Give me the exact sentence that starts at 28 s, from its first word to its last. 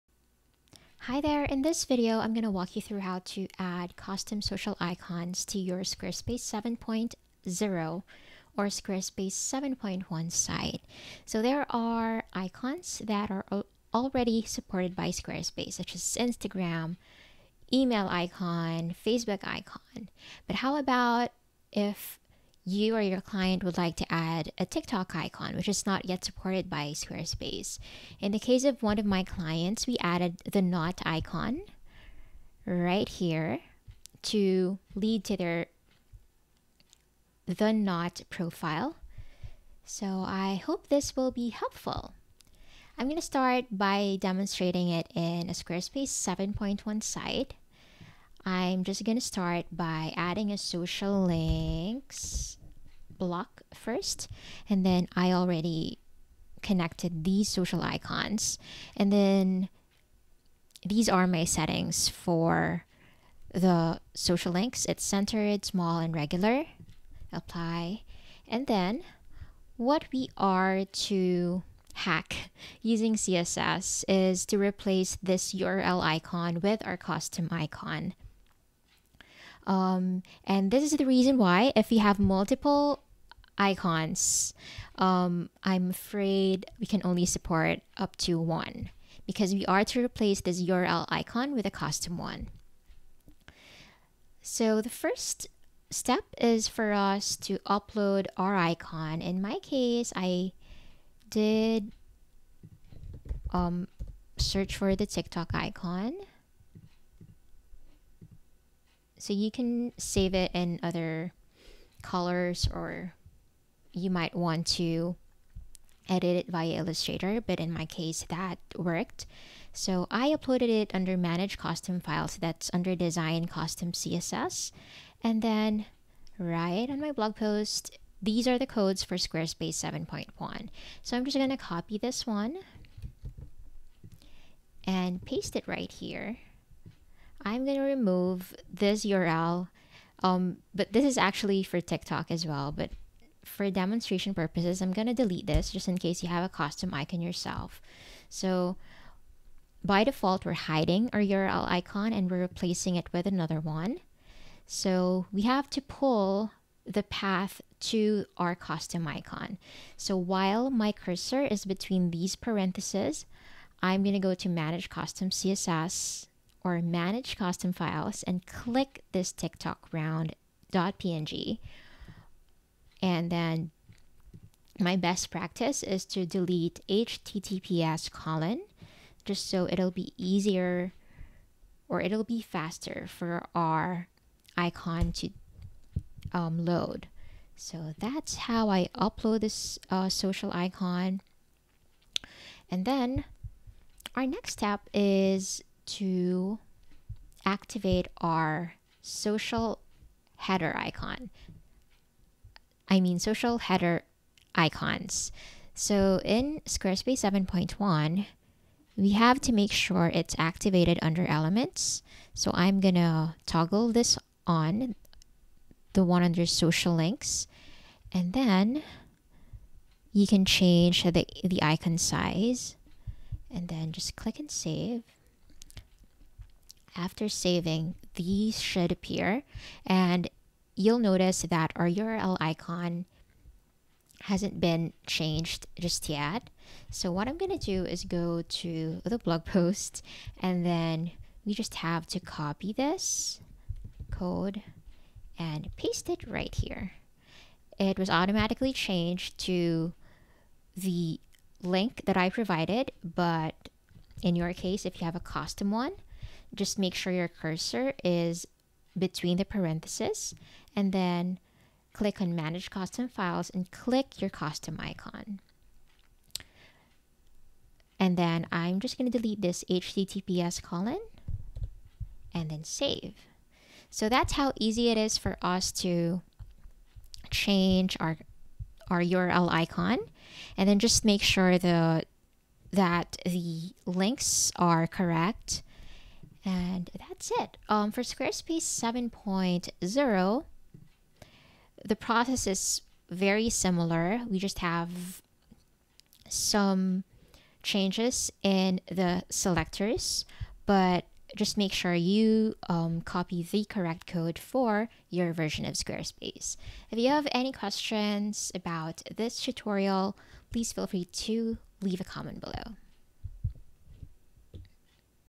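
In the case of one of my clients, we added the Knot icon right here to lead to their the Knot profile.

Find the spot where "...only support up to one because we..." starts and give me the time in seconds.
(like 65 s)
87 s.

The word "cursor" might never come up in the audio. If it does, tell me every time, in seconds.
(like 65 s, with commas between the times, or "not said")
160 s, 257 s.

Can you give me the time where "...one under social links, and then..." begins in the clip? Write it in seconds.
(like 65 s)
216 s.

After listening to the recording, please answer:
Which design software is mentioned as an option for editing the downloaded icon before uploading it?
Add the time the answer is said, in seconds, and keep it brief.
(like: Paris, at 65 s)
Illustrator, at 116 s.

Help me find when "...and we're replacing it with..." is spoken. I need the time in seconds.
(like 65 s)
152 s.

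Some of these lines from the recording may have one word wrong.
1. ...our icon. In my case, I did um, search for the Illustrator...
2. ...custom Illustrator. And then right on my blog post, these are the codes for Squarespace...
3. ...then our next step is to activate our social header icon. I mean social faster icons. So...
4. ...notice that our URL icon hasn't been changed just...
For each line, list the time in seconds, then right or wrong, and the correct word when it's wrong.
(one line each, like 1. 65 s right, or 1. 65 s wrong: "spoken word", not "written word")
1. 98 s wrong: "TikTok", not "Illustrator"
2. 123 s wrong: "CSS", not "Illustrator"
3. 192 s wrong: "header", not "faster"
4. 230 s right.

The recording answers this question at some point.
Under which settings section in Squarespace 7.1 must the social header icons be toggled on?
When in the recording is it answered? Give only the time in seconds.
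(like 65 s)
211 s.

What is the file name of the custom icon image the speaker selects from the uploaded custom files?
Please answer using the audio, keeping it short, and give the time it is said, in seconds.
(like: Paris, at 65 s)
TikTok round .png, at 169 s.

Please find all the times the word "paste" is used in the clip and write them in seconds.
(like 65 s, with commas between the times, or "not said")
135 s, 245 s.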